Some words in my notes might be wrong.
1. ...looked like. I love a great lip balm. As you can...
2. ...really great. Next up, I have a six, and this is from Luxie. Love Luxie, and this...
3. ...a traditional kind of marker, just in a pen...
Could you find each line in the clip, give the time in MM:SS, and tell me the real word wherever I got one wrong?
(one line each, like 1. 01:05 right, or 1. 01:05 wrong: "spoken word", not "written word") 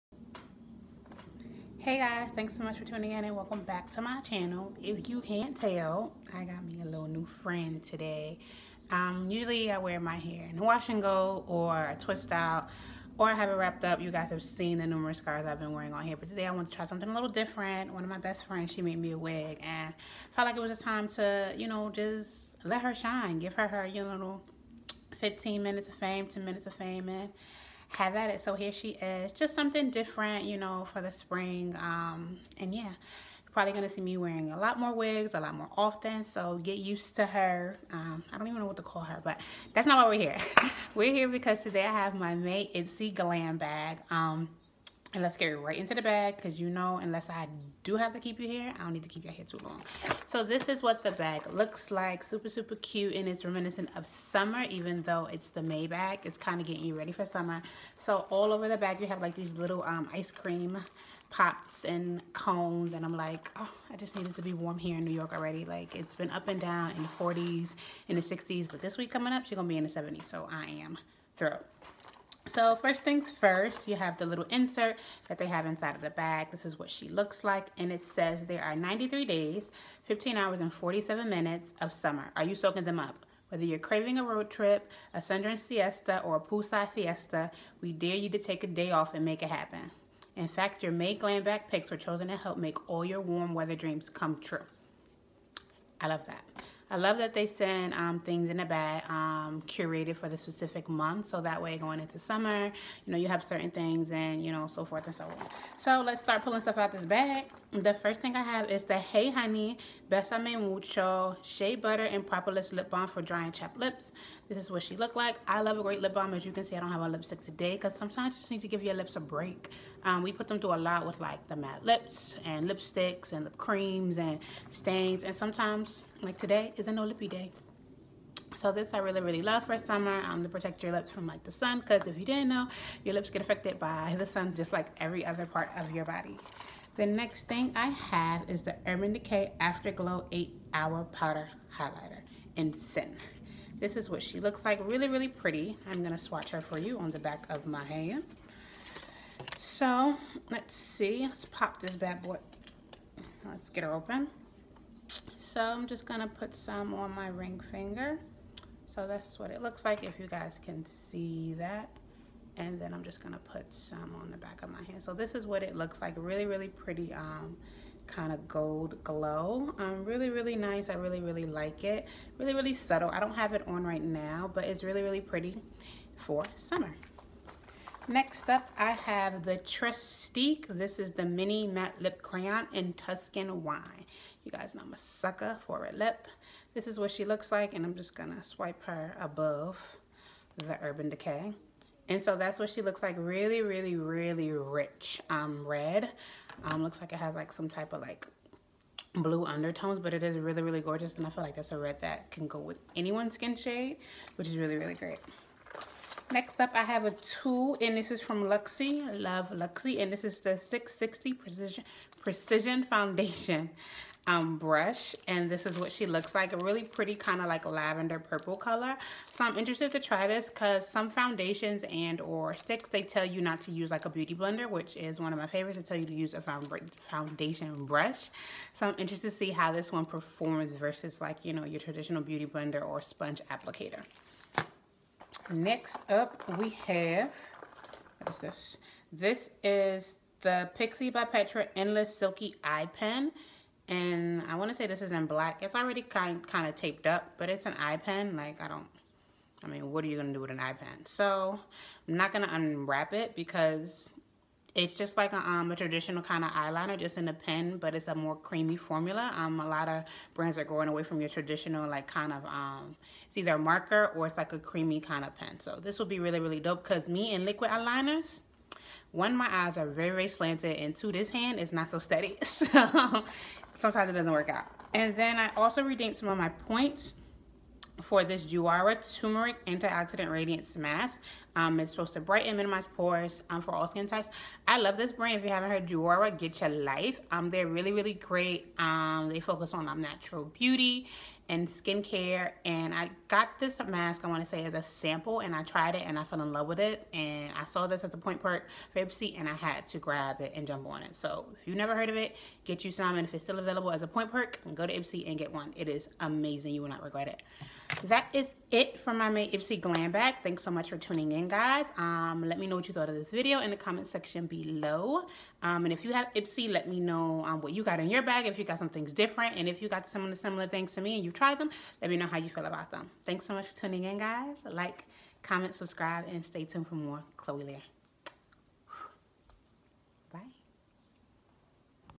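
1. 01:54 right
2. 03:24 wrong: "two", not "six"
3. 04:15 wrong: "eyeliner", not "marker".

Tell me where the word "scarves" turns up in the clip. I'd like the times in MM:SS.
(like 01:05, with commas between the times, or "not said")
00:15.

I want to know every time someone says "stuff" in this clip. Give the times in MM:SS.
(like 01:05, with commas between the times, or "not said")
01:46.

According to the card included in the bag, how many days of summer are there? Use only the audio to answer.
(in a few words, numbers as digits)
93.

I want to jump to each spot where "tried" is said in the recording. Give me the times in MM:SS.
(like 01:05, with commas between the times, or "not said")
04:55, 05:21.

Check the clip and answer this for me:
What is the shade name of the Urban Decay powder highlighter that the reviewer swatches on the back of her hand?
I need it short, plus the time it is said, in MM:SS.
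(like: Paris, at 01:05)
Sin, at 02:22.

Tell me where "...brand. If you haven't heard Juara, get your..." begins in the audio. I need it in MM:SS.
04:45.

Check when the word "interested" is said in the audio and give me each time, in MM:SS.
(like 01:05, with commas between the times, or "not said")
03:39, 03:48.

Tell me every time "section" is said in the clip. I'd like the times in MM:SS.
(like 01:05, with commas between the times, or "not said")
05:14.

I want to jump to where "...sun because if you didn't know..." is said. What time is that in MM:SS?
02:11.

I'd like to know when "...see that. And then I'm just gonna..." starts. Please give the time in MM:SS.
02:40.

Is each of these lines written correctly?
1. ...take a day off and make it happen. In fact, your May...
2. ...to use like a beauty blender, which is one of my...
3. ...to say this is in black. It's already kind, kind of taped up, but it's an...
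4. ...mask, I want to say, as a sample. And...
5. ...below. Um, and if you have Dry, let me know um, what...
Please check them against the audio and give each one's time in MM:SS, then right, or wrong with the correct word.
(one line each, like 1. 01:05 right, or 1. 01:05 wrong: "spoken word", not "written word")
1. 01:28 right
2. 03:43 right
3. 04:04 right
4. 04:53 right
5. 05:14 wrong: "Ipsy", not "Dry".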